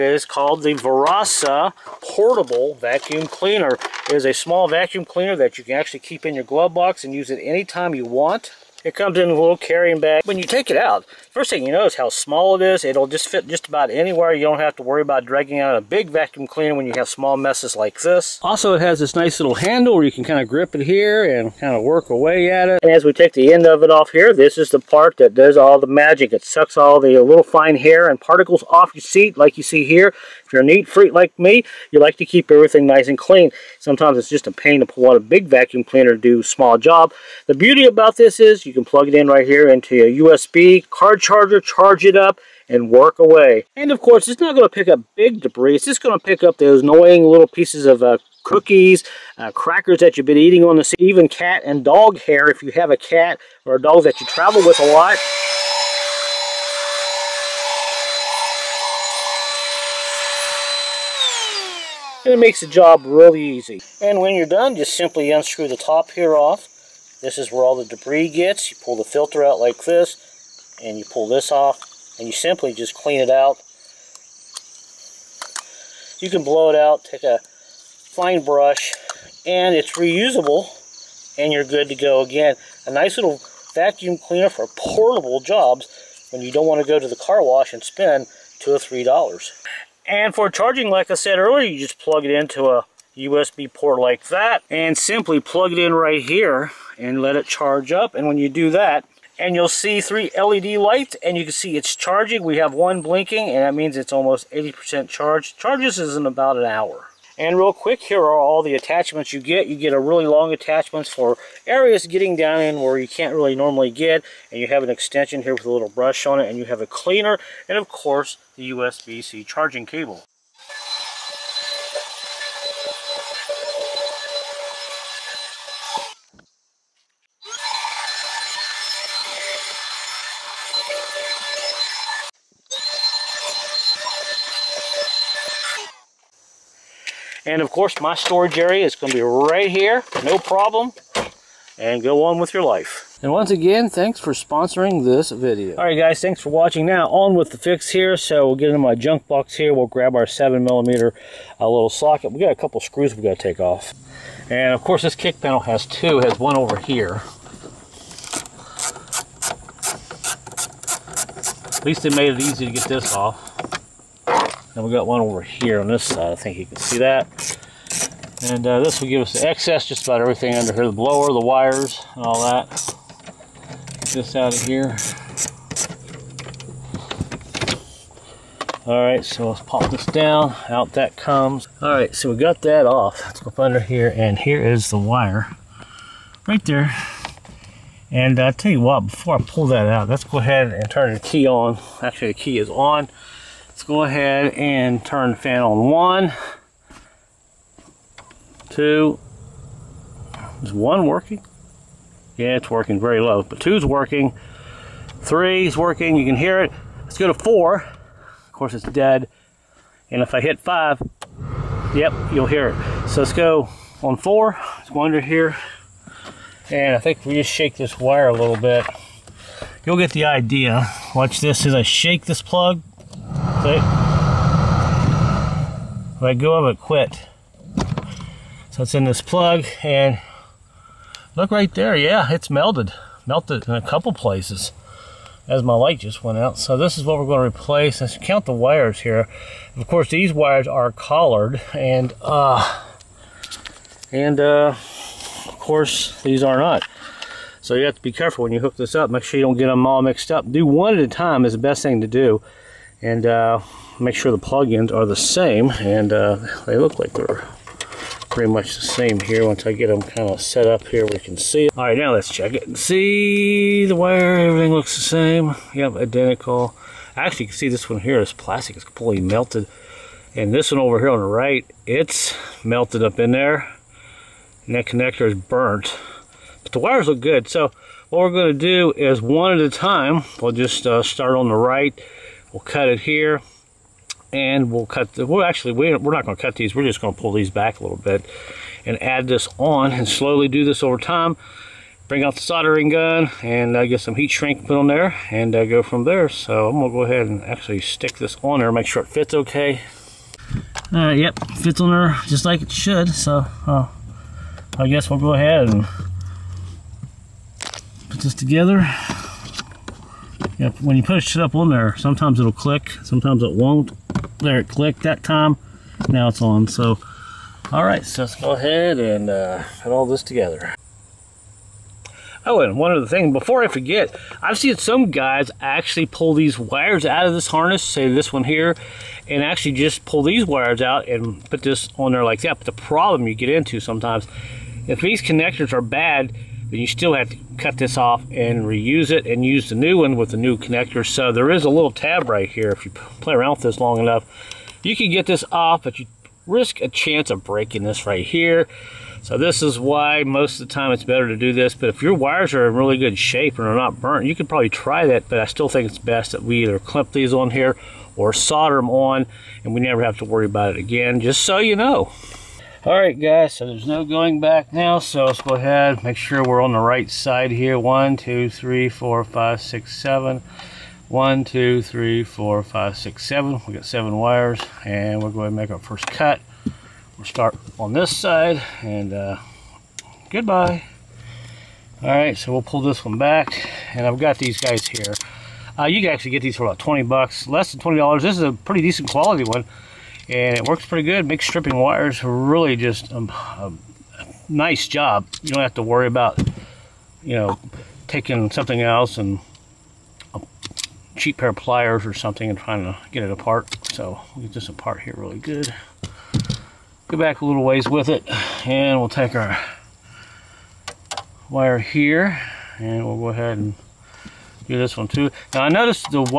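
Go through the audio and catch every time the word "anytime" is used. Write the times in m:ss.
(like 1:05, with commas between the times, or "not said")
0:07.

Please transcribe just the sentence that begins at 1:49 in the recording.
You get a really long attachments for areas getting down in where you can't really normally get.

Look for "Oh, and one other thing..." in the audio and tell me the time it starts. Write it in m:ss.
5:22.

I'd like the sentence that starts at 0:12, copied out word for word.
It'll just fit just about anywhere.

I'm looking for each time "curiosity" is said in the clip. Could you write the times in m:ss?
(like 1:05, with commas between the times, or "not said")
not said.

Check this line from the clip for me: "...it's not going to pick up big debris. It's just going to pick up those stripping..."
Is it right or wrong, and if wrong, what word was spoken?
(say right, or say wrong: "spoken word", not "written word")
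wrong: "annoying", not "stripping".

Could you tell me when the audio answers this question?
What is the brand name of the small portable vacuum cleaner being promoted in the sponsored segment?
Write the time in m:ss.
0:00.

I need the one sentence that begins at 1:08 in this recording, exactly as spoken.
You pull the filter out like this, and you pull this off, and you simply just clean it out.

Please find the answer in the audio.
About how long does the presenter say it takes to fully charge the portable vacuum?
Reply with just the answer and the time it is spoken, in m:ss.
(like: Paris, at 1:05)
about an hour, at 1:46.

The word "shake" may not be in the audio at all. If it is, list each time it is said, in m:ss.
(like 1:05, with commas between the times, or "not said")
3:37, 3:41.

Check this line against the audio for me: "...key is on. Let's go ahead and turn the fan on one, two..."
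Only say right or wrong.
right.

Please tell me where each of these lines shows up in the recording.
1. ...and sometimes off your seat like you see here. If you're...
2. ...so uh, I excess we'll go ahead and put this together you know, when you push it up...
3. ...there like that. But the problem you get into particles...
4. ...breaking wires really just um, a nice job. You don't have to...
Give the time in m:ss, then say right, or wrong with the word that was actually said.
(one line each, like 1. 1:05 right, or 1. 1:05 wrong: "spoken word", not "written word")
1. 0:28 wrong: "particles", not "sometimes"
2. 5:03 wrong: "guess", not "excess"
3. 5:32 wrong: "sometimes", not "particles"
4. 6:31 wrong: "stripping", not "breaking".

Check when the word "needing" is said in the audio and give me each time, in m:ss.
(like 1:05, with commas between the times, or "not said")
not said.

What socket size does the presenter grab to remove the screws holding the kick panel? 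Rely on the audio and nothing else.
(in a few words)
7mm.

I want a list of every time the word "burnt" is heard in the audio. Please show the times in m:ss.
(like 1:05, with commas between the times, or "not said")
4:35, 5:54.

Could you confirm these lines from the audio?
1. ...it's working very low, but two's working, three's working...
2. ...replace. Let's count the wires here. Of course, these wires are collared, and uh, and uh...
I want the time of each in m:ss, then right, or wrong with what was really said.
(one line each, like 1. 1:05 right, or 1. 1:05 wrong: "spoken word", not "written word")
1. 3:22 right
2. 3:57 right.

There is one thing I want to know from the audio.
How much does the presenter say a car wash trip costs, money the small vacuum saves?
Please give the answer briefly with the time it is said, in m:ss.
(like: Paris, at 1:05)
2 or 3 dollars, at 1:28.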